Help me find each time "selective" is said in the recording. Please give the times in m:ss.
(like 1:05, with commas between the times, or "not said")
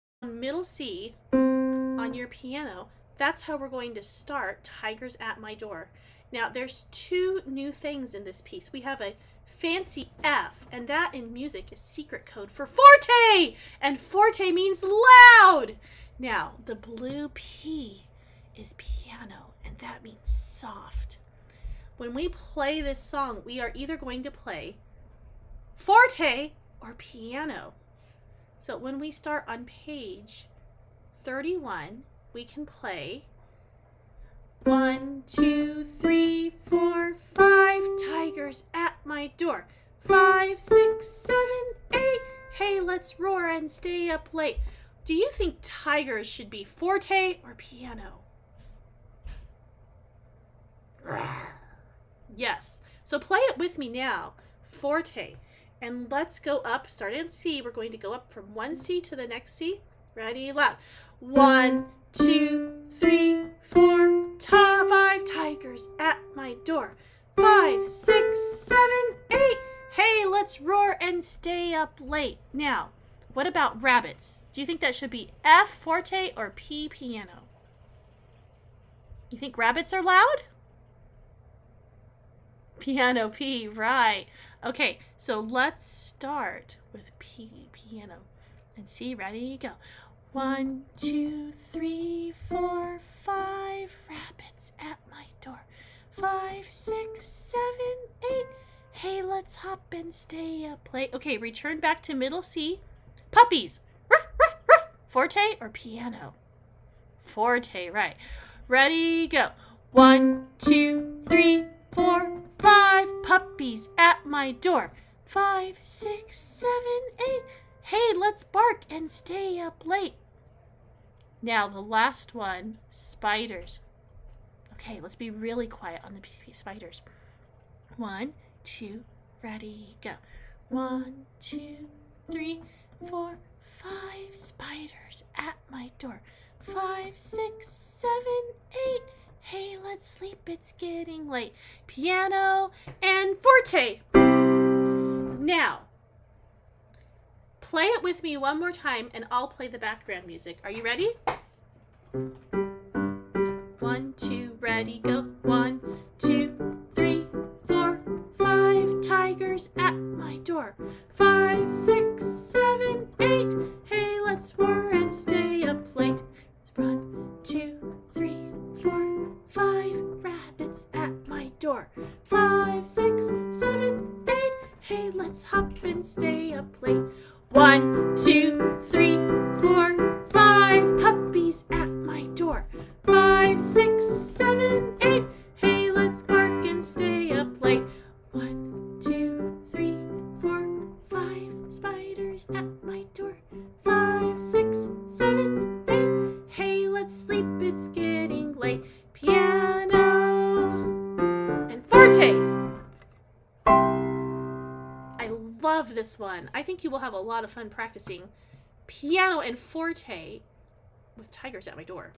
not said.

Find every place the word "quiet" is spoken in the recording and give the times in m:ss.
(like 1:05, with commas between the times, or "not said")
2:05.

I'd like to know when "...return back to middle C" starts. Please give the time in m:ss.
1:41.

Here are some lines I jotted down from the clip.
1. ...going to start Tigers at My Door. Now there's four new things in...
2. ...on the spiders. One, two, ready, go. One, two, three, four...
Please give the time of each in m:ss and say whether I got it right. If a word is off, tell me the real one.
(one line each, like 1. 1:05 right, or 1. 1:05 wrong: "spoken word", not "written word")
1. 0:03 wrong: "two", not "four"
2. 2:06 right.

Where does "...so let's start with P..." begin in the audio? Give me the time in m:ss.
1:25.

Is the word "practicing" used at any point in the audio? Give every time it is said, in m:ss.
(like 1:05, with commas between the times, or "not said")
3:27.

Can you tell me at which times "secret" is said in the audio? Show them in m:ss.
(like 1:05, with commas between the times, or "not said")
0:11.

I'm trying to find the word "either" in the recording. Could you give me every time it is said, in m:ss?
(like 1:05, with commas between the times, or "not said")
0:23.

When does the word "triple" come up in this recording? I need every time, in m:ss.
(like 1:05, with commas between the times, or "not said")
not said.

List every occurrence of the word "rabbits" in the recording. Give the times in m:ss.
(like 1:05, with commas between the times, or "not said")
1:13, 1:19, 1:34.